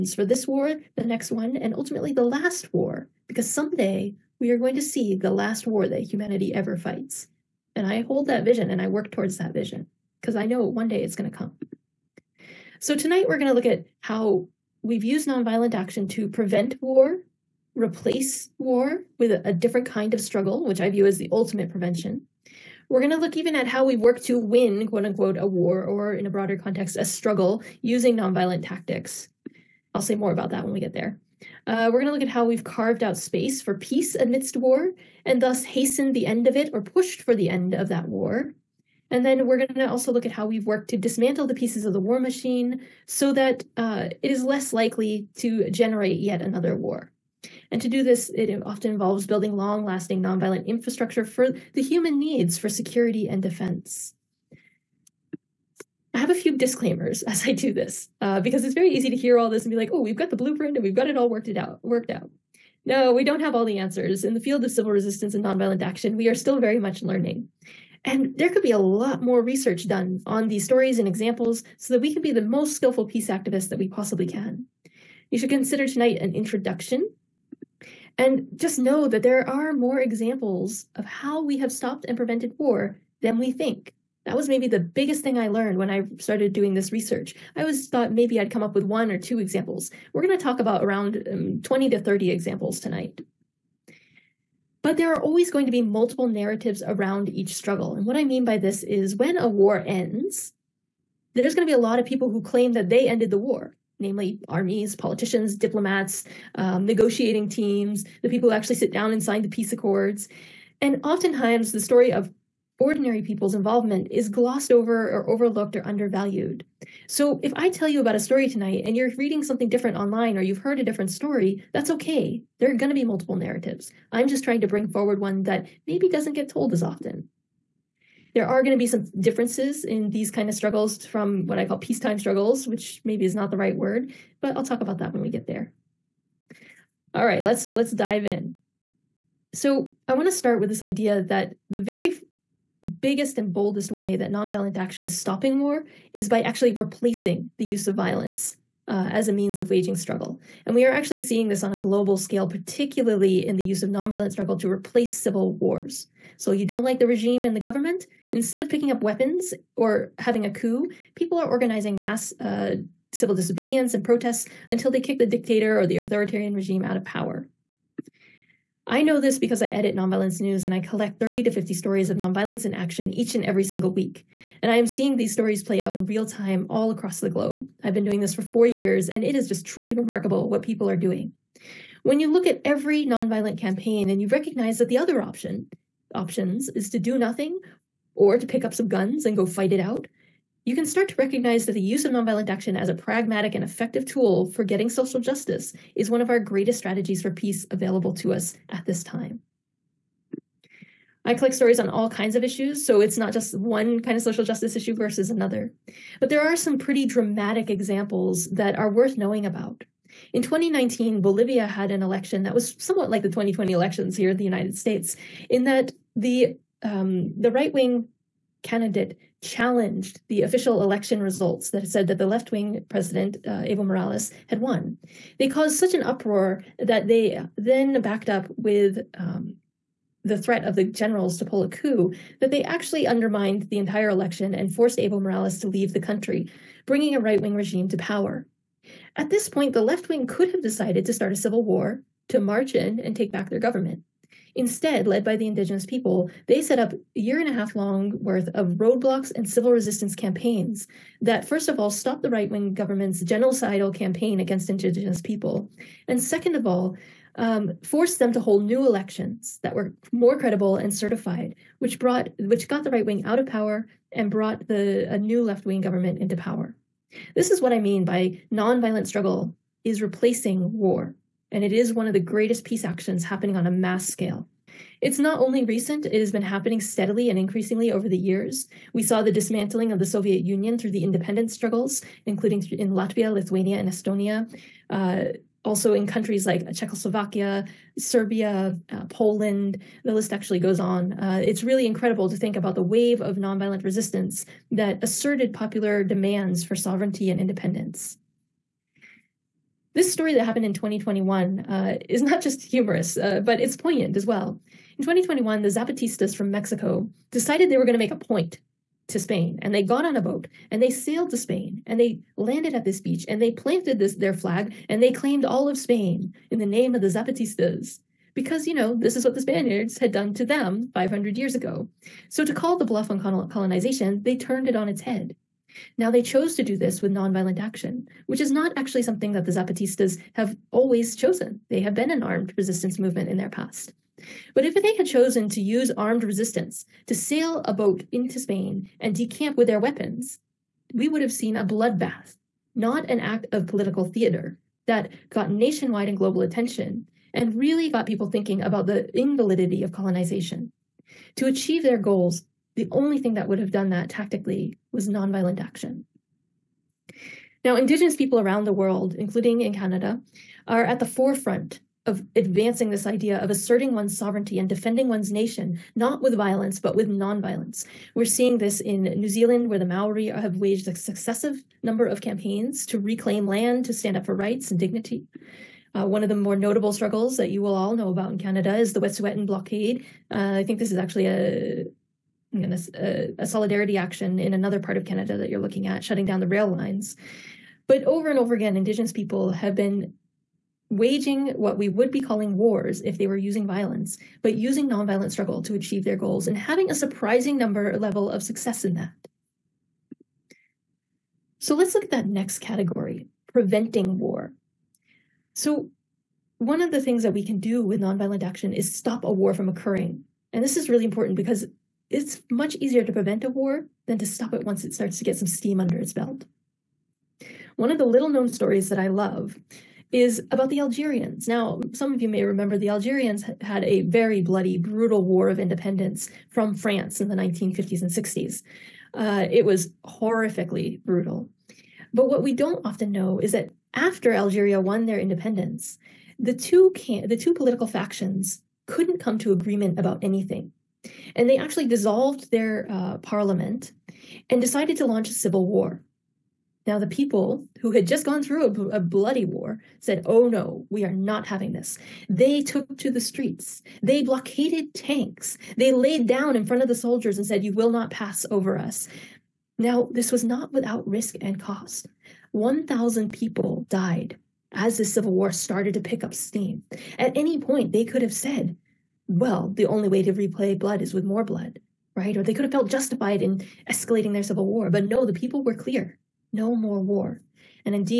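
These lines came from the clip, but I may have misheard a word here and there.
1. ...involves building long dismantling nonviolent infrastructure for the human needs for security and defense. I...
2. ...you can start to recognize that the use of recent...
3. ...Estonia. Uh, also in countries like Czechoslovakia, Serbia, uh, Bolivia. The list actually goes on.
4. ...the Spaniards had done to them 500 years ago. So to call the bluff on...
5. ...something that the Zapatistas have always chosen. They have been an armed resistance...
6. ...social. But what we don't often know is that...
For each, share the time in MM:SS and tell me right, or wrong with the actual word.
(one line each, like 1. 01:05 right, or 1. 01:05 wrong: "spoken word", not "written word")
1. 00:48 wrong: "lasting", not "dismantling"
2. 03:10 wrong: "nonviolent", not "recent"
3. 04:43 wrong: "Poland", not "Bolivia"
4. 05:19 right
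5. 05:29 right
6. 07:11 wrong: "brutal", not "social".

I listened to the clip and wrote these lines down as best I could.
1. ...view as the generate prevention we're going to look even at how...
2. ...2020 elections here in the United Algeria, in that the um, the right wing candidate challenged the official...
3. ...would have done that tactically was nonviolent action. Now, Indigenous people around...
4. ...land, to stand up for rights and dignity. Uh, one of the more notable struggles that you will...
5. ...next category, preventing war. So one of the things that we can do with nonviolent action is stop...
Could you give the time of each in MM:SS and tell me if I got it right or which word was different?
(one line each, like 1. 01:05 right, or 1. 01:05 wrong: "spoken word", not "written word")
1. 00:20 wrong: "ultimate", not "generate"
2. 03:33 wrong: "States", not "Algeria"
3. 05:53 right
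4. 06:13 right
5. 06:42 right.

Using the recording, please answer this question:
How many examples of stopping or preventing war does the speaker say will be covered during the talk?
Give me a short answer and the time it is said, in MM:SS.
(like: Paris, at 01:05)
20 to 30, at 01:31.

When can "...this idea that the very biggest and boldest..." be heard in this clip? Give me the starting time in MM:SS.
02:20.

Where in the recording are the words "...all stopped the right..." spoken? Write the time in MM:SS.
04:11.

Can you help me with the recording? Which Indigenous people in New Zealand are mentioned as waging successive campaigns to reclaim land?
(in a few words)
Maori.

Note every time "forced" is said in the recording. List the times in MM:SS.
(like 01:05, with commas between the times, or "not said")
03:54, 04:17.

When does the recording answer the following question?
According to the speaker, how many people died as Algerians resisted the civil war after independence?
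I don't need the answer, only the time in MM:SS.
07:42.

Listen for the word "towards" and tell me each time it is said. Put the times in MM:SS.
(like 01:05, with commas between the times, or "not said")
00:09.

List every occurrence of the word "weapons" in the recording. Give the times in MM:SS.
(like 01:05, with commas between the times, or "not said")
02:39, 05:39.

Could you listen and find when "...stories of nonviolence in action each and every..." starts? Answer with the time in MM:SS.
02:51.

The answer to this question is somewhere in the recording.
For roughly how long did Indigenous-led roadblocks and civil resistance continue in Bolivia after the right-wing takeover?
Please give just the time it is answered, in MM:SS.
04:06.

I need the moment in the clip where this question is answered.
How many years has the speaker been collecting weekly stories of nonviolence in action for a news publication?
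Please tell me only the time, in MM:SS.
02:58.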